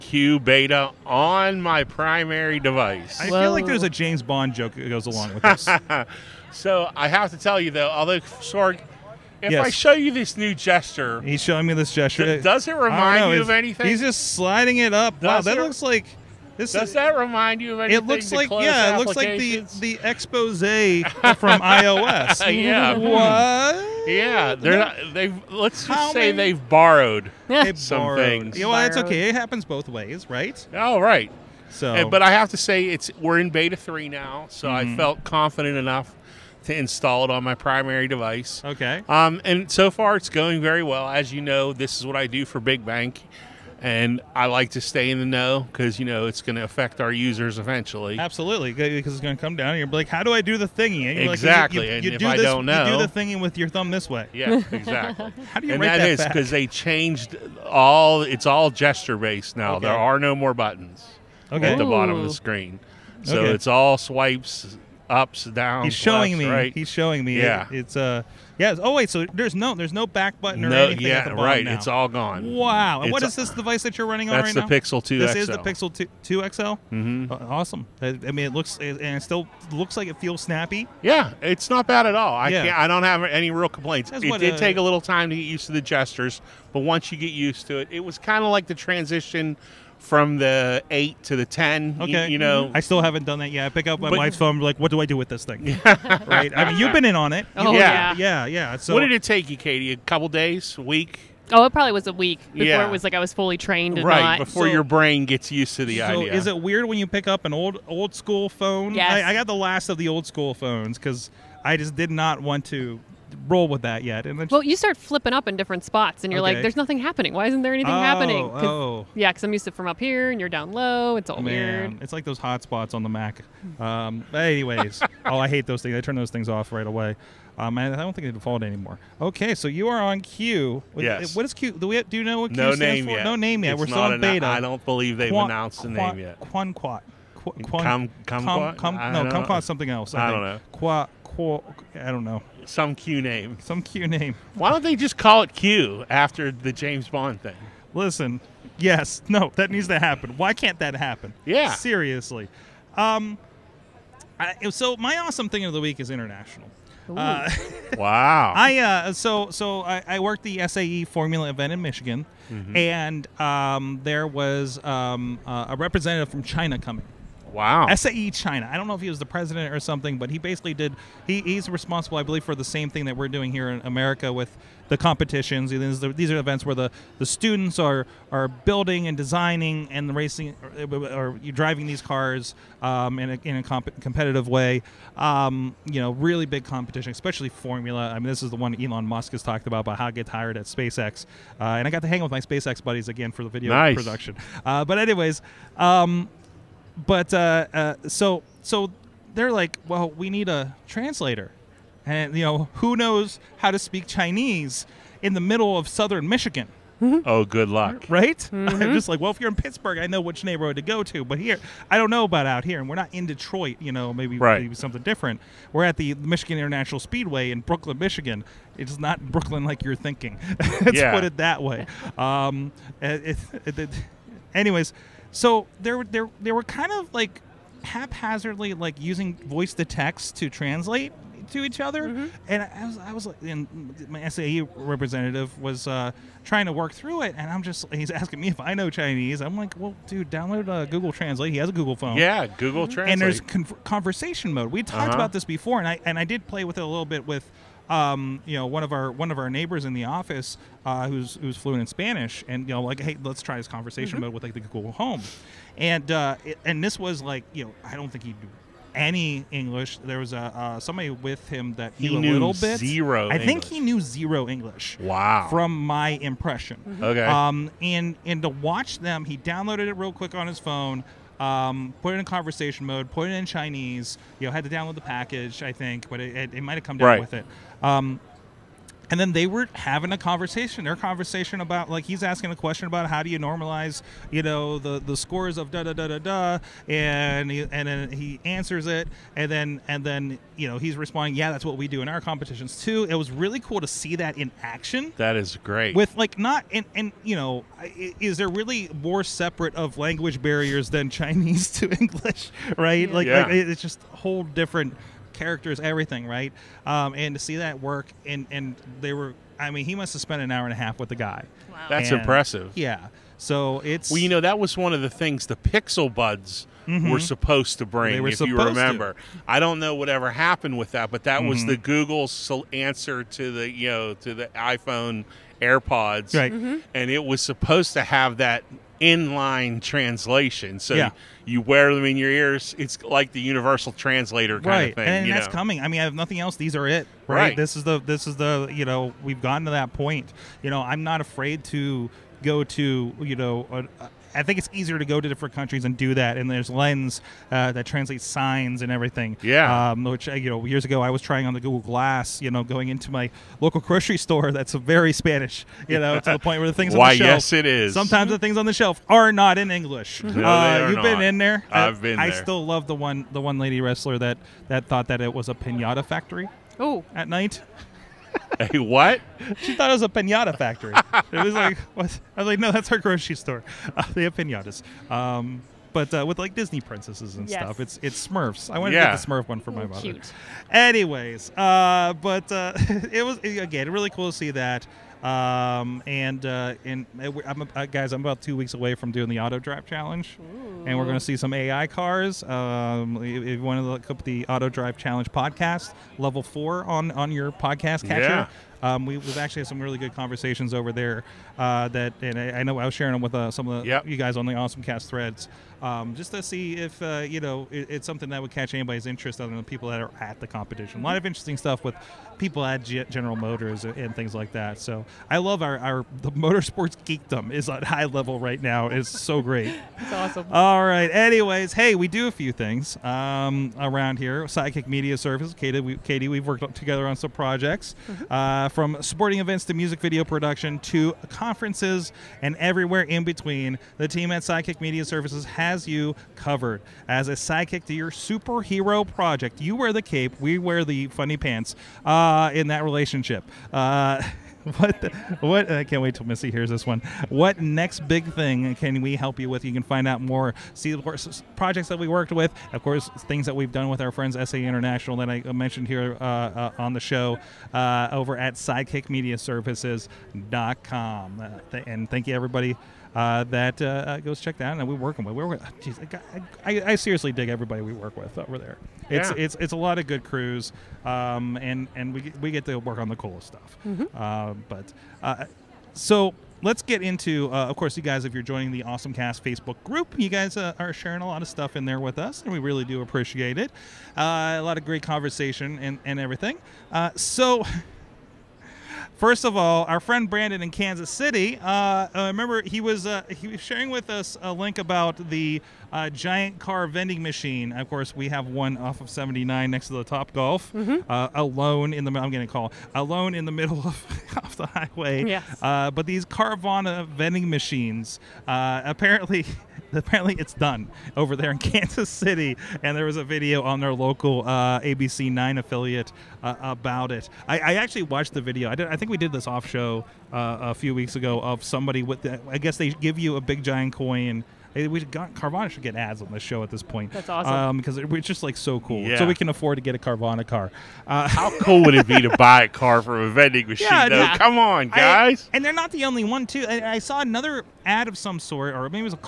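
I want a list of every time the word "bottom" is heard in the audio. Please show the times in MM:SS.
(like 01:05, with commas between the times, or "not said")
01:01, 01:11.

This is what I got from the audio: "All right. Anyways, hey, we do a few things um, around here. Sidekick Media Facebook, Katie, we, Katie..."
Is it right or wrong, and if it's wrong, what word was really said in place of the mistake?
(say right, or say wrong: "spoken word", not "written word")
wrong: "Service", not "Facebook".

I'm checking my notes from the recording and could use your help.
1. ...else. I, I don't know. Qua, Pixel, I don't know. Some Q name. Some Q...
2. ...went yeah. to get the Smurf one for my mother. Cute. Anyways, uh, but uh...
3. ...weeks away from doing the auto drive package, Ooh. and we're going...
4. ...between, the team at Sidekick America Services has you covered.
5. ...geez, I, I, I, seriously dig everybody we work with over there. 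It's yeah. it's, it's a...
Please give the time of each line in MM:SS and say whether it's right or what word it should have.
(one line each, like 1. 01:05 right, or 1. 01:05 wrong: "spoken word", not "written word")
1. 02:19 wrong: "Qua", not "Pixel"
2. 06:18 right
3. 06:28 wrong: "challenge", not "package"
4. 07:13 wrong: "Media", not "America"
5. 07:45 right.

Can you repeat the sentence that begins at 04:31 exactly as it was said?
Um, put it in conversation mode, put it in Chinese.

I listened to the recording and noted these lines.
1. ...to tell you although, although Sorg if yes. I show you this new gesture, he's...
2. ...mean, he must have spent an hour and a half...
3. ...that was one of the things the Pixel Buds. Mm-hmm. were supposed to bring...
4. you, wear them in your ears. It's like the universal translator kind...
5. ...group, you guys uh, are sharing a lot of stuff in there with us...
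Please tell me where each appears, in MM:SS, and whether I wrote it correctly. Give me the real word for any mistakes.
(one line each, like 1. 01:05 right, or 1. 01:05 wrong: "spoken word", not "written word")
1. 00:07 wrong: "though", not "although"
2. 05:09 right
3. 05:14 right
4. 05:31 right
5. 07:59 right.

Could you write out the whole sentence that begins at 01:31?
Okay, you, you know, I still haven't done that yet.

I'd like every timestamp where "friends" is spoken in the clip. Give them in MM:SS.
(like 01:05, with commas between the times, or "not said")
07:34, 08:09.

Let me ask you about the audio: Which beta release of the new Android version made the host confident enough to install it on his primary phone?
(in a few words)
beta three.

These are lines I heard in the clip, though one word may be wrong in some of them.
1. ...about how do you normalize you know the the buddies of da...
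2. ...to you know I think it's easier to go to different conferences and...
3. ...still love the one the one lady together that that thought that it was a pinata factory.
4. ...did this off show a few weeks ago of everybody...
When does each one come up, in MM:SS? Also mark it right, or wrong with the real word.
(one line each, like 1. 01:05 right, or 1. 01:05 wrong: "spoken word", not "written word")
1. 04:42 wrong: "scores", not "buddies"
2. 05:42 wrong: "countries", not "conferences"
3. 06:02 wrong: "wrestler", not "together"
4. 08:39 wrong: "somebody", not "everybody".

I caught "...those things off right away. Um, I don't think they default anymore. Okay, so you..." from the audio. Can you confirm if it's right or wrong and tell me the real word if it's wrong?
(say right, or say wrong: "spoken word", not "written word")
right.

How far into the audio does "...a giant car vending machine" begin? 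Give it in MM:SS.
08:15.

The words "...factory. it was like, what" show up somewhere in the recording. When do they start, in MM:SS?
06:10.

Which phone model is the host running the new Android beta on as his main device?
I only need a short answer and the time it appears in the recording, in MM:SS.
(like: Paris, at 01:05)
Pixel 2 XL, at 01:15.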